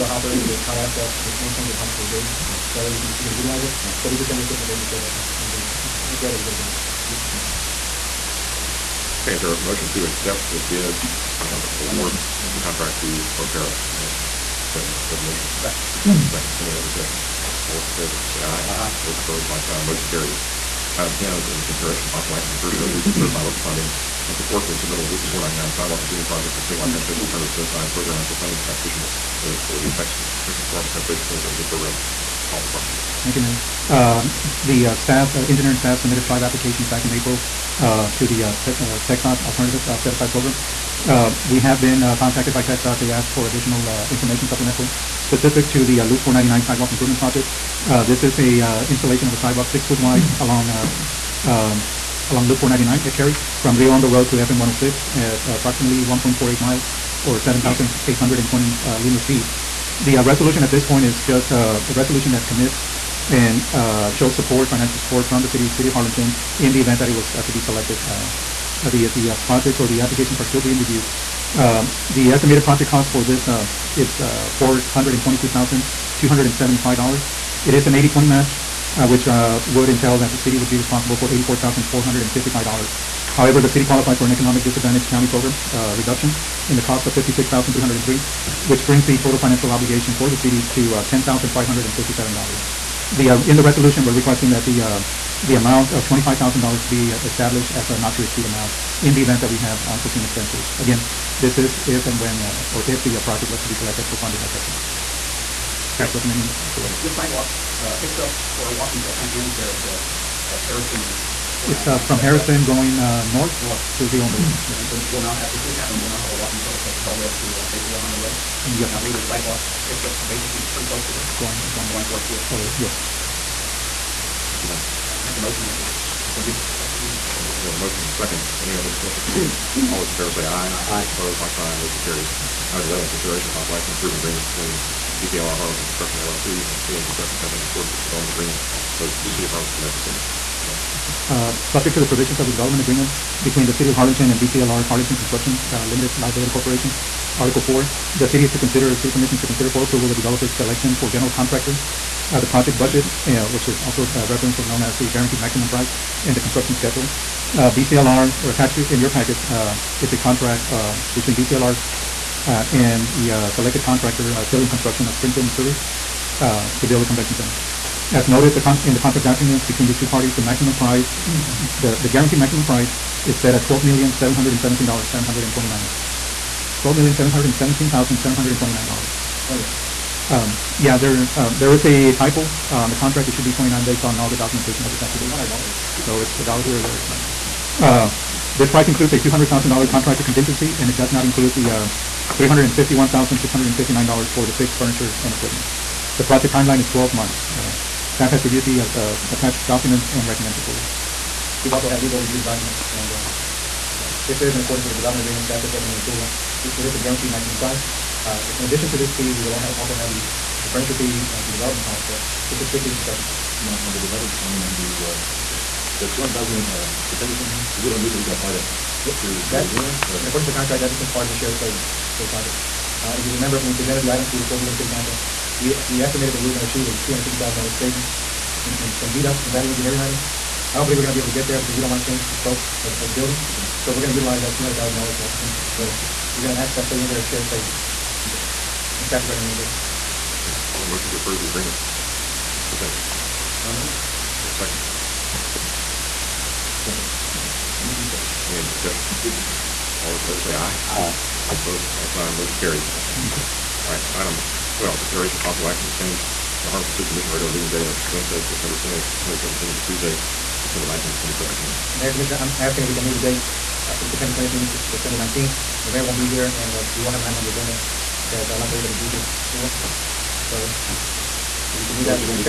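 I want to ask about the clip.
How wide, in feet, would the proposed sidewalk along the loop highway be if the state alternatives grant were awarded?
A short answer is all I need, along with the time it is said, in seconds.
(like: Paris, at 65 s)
6 feet, at 49 s.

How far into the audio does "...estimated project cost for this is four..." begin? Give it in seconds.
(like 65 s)
72 s.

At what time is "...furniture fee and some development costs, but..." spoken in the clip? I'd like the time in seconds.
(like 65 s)
210 s.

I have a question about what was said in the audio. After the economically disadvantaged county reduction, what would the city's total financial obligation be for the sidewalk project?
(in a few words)
$10,557.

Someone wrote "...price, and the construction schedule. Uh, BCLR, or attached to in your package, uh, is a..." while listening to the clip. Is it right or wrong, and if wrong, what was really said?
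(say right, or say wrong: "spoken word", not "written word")
right.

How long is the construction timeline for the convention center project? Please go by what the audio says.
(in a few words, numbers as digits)
12 months.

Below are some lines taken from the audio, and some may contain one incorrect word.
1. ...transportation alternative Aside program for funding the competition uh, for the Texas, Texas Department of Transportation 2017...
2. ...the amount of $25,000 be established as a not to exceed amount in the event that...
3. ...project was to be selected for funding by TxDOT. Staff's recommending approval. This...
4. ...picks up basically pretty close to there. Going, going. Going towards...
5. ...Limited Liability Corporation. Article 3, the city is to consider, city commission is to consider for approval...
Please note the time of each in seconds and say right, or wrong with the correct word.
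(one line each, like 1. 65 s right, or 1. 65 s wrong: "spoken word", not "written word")
1. 26 s right
2. 95 s right
3. 103 s right
4. 119 s right
5. 145 s wrong: "4", not "3".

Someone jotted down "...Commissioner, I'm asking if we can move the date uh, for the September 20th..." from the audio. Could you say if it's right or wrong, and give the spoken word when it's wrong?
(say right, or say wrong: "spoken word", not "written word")
right.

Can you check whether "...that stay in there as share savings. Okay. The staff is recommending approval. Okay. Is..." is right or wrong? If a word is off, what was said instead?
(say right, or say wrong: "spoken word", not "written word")
right.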